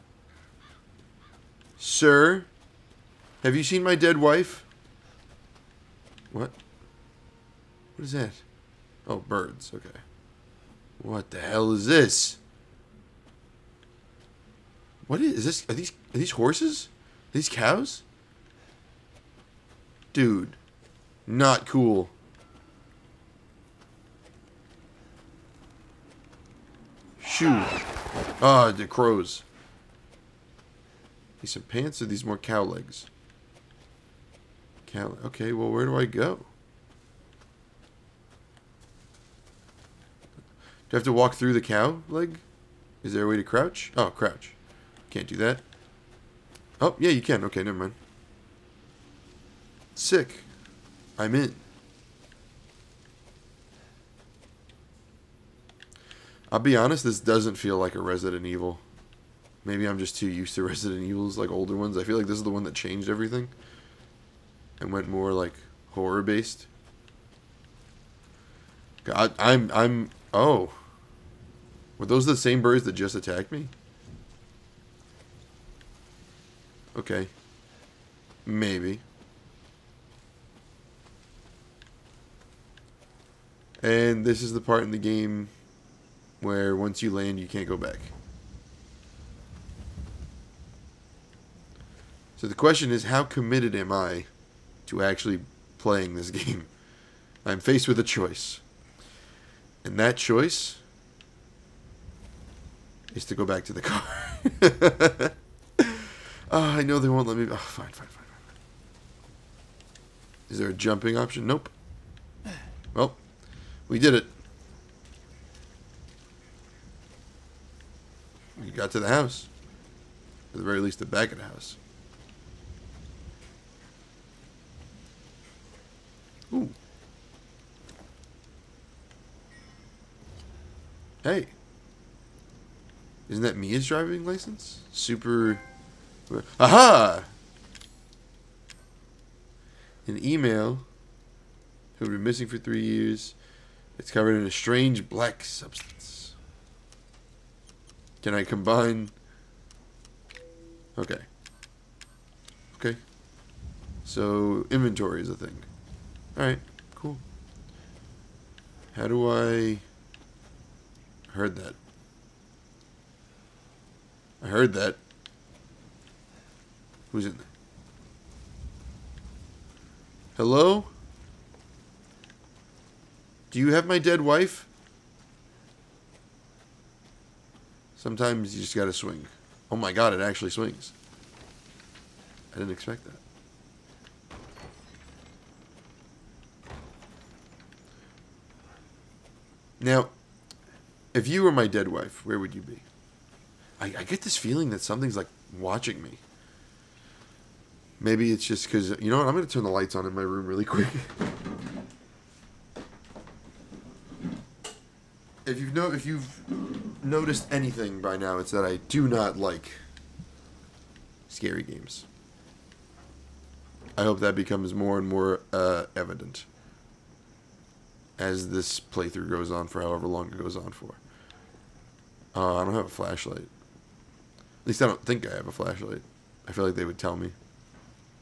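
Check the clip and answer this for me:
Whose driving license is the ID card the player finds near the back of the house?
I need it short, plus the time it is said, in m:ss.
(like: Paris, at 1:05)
Mia, at 2:13.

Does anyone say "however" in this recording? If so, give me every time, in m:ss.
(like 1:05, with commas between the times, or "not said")
3:39.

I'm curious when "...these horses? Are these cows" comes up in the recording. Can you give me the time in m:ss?
0:16.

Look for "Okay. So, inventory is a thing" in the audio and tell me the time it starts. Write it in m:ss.
2:32.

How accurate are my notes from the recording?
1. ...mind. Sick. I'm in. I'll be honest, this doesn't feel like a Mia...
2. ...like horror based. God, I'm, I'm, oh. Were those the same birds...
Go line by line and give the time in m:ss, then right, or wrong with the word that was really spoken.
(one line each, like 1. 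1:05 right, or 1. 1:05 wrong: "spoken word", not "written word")
1. 0:47 wrong: "Resident", not "Mia"
2. 1:05 right.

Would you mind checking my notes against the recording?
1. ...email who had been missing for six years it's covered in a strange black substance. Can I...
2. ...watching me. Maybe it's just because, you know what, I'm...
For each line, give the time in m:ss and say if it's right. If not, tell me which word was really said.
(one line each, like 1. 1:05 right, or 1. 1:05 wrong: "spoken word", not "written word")
1. 2:20 wrong: "three", not "six"
2. 3:15 right.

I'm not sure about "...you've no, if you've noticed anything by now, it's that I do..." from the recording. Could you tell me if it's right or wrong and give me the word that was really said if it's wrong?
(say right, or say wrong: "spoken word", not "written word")
right.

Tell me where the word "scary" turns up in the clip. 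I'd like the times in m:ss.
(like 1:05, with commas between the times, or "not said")
3:31.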